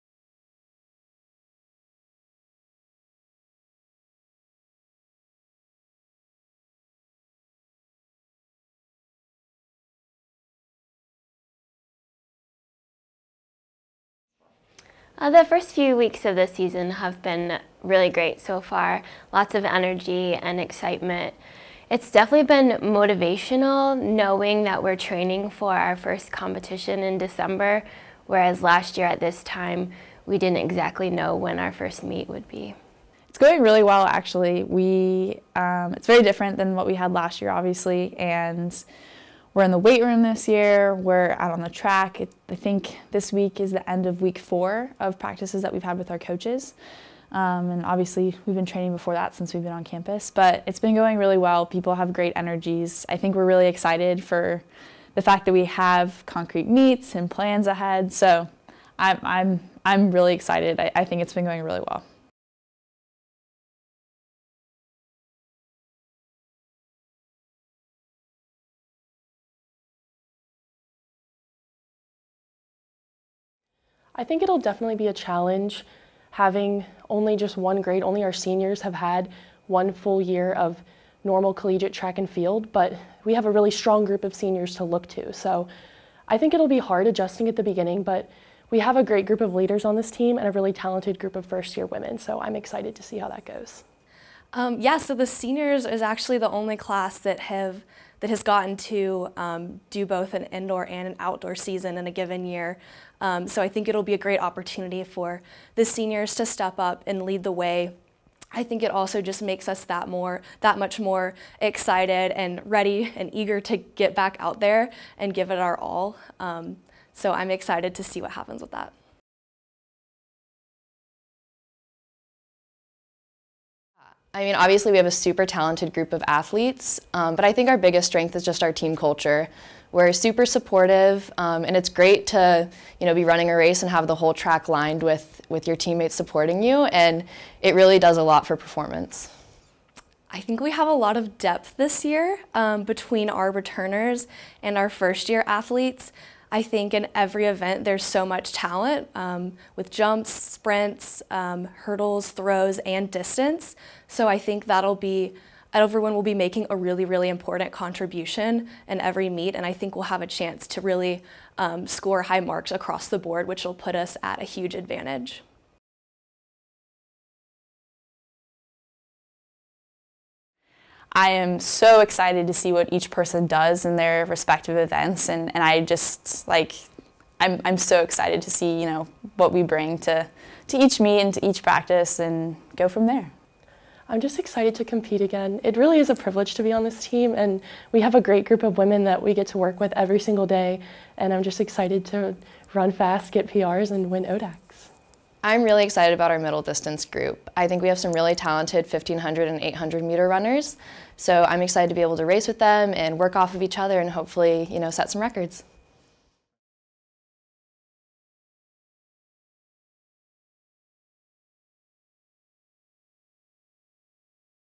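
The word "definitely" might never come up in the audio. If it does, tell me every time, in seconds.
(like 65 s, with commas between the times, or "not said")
22 s, 74 s.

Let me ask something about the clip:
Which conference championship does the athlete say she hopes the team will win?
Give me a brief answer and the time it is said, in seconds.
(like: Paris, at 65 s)
ODACs, at 194 s.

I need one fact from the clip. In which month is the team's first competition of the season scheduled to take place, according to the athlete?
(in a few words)
December.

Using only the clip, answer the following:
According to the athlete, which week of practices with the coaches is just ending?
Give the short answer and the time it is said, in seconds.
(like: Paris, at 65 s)
week 4, at 44 s.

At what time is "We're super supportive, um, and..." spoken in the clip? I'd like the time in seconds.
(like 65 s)
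129 s.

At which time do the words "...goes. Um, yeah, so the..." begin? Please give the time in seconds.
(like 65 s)
93 s.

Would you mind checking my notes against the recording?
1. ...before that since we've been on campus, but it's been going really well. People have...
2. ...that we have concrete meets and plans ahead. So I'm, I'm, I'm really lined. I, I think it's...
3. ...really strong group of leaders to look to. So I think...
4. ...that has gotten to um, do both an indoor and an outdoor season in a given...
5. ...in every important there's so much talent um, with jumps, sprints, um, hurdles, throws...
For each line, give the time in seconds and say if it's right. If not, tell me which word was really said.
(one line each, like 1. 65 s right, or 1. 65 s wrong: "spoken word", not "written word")
1. 48 s right
2. 55 s wrong: "excited", not "lined"
3. 83 s wrong: "seniors", not "leaders"
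4. 98 s right
5. 146 s wrong: "event", not "important".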